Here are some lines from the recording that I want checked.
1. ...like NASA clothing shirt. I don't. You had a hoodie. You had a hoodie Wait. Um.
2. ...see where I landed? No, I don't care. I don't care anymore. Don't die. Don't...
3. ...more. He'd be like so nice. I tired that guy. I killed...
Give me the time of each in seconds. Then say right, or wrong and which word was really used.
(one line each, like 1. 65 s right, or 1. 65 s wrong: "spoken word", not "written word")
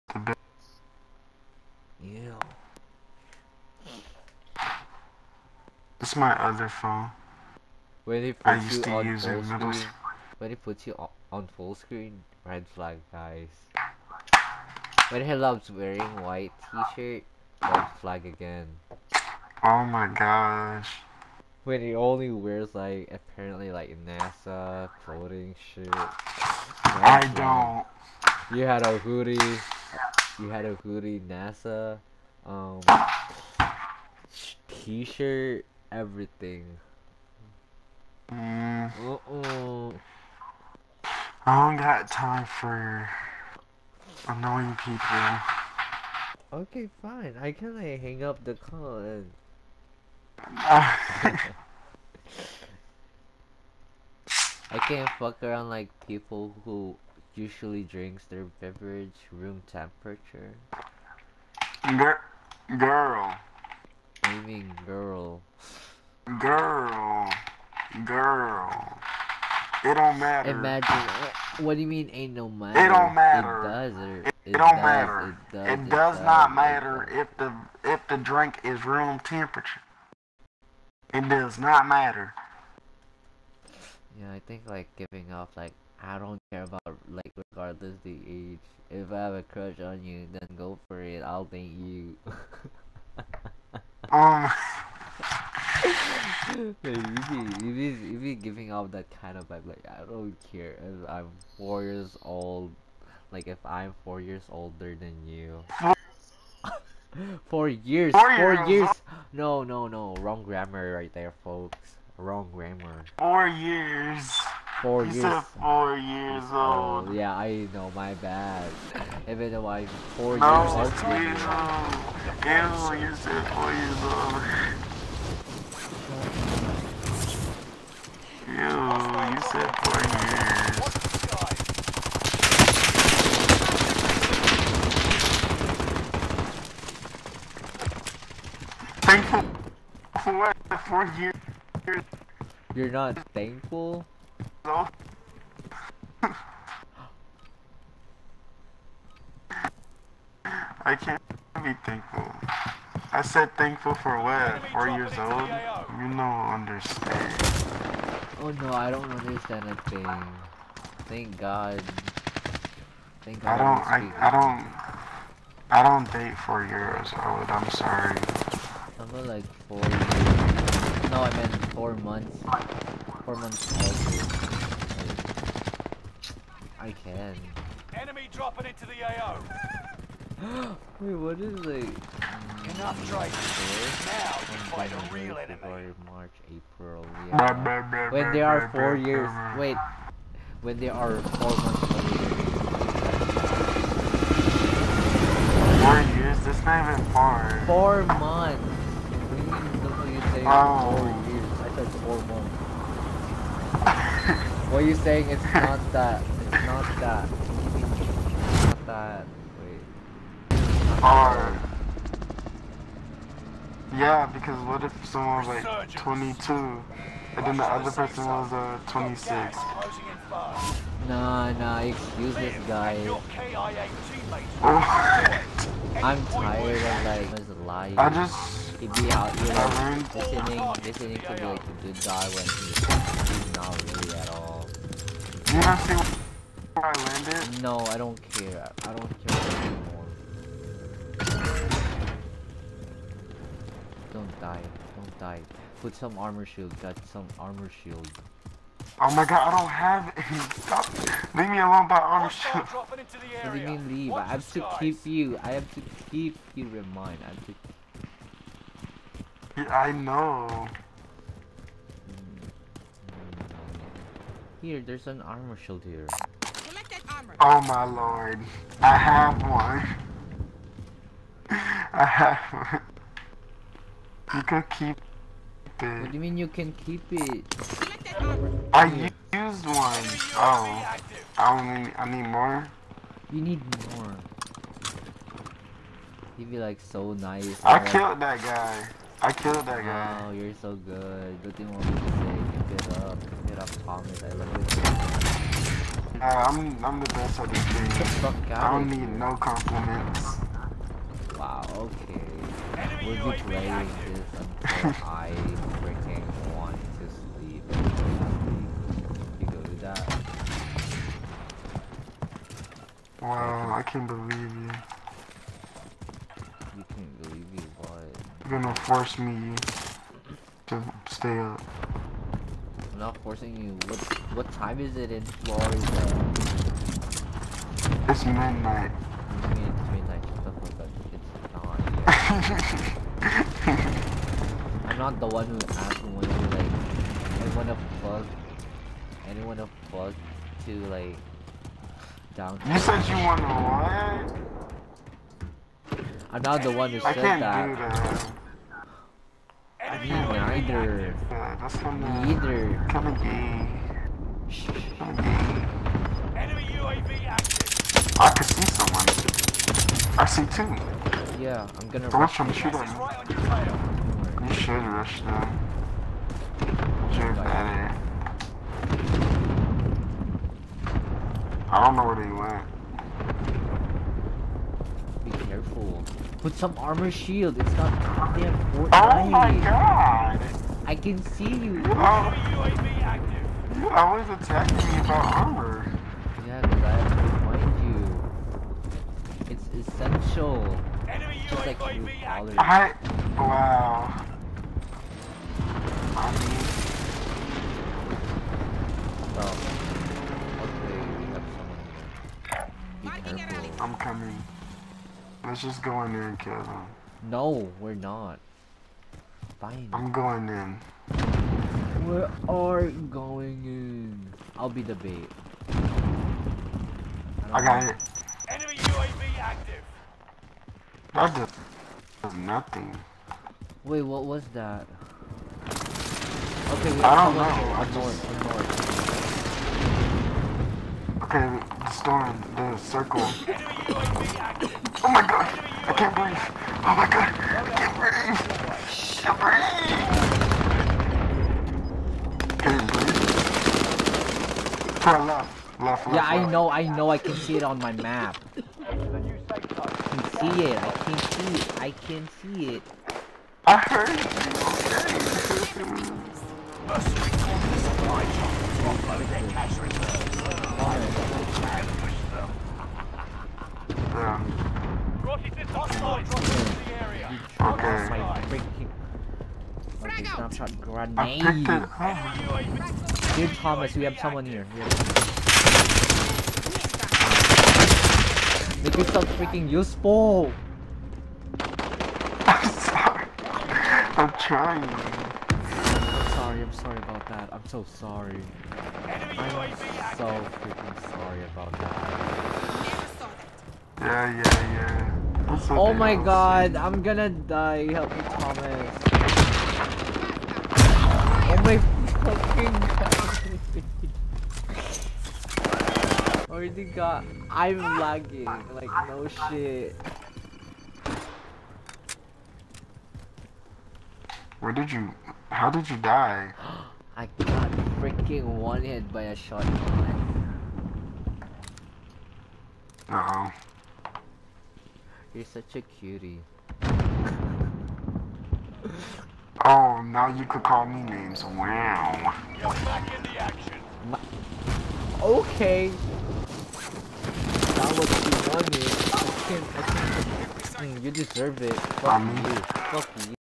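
1. 23 s wrong: "NASA", not "Wait"
2. 235 s right
3. 283 s wrong: "killed", not "tired".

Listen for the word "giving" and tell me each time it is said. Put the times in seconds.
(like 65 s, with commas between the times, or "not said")
84 s, 98 s.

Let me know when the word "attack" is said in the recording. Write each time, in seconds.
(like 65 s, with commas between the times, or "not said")
384 s.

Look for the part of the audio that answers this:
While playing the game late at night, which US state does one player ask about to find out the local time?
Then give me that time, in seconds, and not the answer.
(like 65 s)
325 s.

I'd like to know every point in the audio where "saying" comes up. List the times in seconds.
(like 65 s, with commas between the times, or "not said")
200 s, 204 s.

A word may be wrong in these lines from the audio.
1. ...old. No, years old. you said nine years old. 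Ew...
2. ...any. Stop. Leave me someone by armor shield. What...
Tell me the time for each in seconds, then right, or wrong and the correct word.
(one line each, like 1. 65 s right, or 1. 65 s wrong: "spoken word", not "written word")
1. 120 s wrong: "four", not "nine"
2. 250 s wrong: "alone", not "someone".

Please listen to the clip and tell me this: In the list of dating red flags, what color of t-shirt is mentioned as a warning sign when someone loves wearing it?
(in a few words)
White.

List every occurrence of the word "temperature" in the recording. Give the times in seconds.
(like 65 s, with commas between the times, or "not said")
59 s, 79 s.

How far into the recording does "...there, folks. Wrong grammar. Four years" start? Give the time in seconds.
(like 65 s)
111 s.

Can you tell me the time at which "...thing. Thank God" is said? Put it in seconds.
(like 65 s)
159 s.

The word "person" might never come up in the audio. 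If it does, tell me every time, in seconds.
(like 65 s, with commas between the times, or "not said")
217 s.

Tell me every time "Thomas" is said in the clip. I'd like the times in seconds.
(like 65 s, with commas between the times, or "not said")
293 s, 473 s, 498 s.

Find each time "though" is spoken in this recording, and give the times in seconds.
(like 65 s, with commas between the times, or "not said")
119 s, 144 s.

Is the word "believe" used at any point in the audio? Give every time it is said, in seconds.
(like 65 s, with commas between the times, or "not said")
314 s.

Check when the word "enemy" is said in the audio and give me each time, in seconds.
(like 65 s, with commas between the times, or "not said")
177 s, 185 s, 302 s, 356 s, 391 s, 418 s.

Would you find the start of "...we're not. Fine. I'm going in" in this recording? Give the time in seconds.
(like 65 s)
407 s.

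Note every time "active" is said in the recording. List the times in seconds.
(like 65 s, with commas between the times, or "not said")
357 s, 381 s, 419 s.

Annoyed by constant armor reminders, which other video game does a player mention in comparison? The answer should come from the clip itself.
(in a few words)
Fortnite.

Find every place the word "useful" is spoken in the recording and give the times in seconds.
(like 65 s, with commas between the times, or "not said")
479 s.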